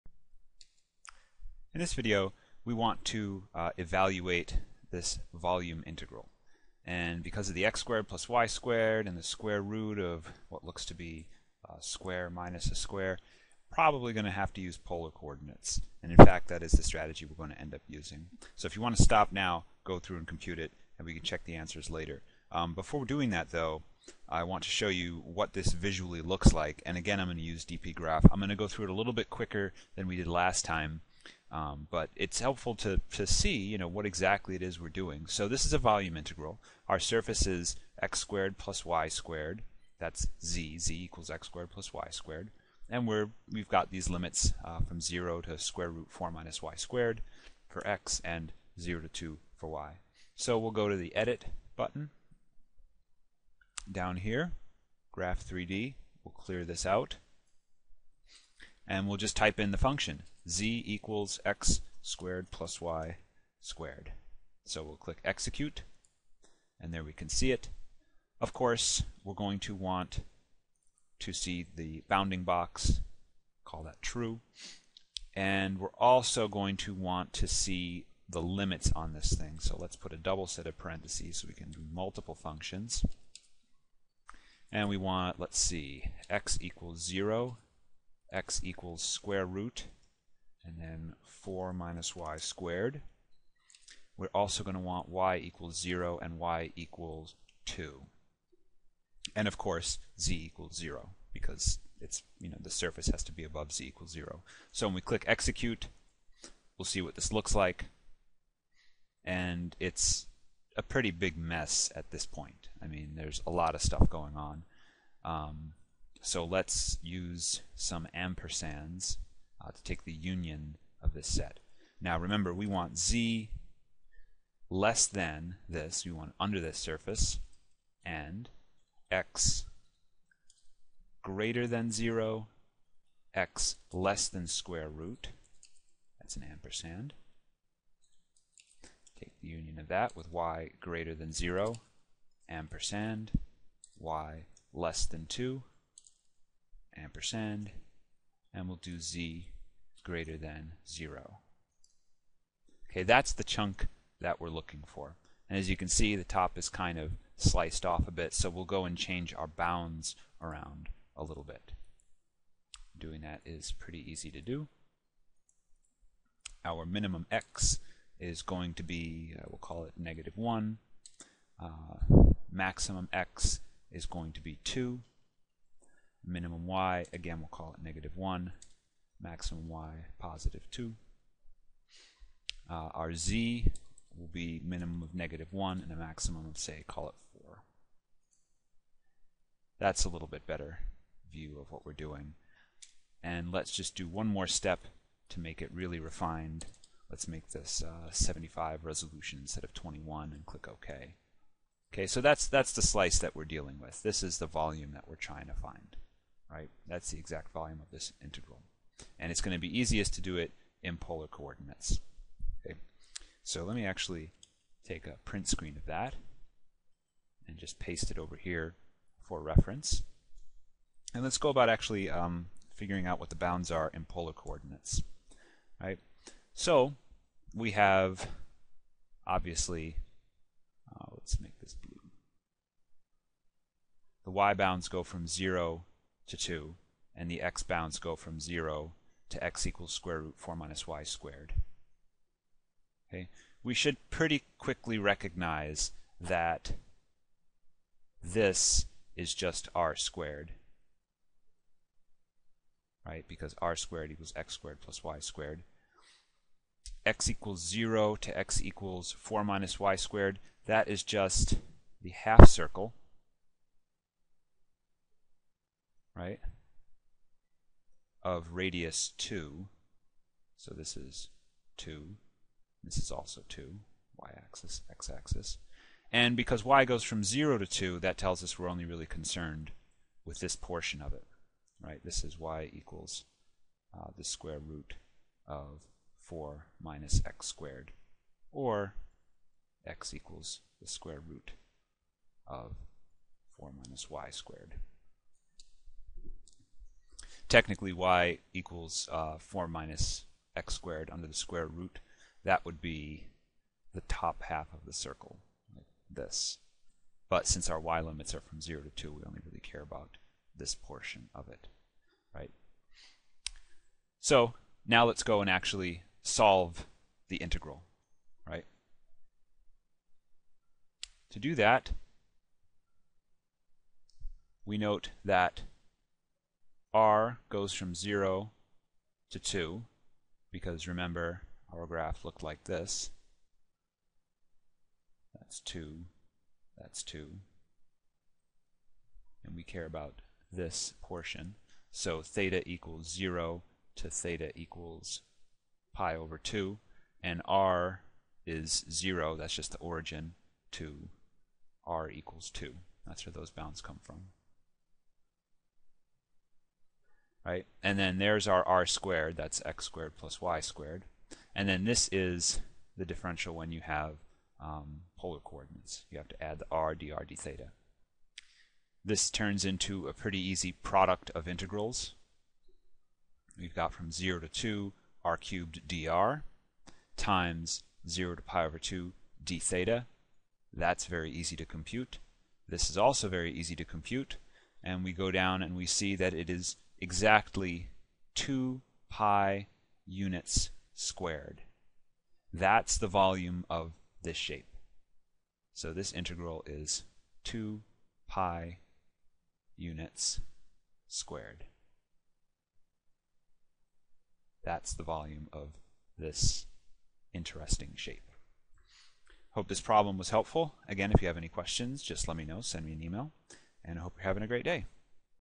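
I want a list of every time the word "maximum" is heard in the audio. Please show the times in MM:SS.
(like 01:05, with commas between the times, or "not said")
02:52, 02:59, 03:05.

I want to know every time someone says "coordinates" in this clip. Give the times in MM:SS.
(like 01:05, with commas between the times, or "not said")
00:15, 03:31, 03:44, 06:05.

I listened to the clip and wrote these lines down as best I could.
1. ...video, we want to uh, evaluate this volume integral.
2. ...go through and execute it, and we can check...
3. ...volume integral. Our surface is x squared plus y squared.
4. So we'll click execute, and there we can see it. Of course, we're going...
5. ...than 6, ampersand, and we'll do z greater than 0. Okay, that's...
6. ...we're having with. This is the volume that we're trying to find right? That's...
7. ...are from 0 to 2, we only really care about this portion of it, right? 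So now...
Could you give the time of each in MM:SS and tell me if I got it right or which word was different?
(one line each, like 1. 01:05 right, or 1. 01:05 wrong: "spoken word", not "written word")
1. 00:01 right
2. 00:19 wrong: "compute", not "execute"
3. 00:35 right
4. 01:04 right
5. 02:25 wrong: "2", not "6"
6. 03:23 wrong: "dealing", not "having"
7. 05:08 right.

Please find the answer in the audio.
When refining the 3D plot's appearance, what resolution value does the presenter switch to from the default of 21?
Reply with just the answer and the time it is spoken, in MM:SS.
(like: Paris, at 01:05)
75, at 03:18.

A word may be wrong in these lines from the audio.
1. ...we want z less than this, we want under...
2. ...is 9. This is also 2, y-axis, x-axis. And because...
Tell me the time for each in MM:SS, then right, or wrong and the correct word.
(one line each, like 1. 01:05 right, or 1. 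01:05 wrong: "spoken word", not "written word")
1. 02:02 right
2. 04:30 wrong: "2", not "9".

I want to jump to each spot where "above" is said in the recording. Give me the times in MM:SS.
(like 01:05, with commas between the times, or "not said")
01:43.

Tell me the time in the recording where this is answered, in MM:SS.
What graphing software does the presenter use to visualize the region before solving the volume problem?
00:27.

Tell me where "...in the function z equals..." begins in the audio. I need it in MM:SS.
00:59.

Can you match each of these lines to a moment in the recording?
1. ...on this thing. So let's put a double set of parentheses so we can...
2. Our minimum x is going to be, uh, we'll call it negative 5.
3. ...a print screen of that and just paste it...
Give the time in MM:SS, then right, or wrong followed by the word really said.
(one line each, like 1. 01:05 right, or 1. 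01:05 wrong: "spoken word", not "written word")
1. 01:18 right
2. 02:46 wrong: "1", not "5"
3. 03:35 right.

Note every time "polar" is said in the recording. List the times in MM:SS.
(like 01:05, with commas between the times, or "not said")
00:14, 03:30, 03:44, 06:05.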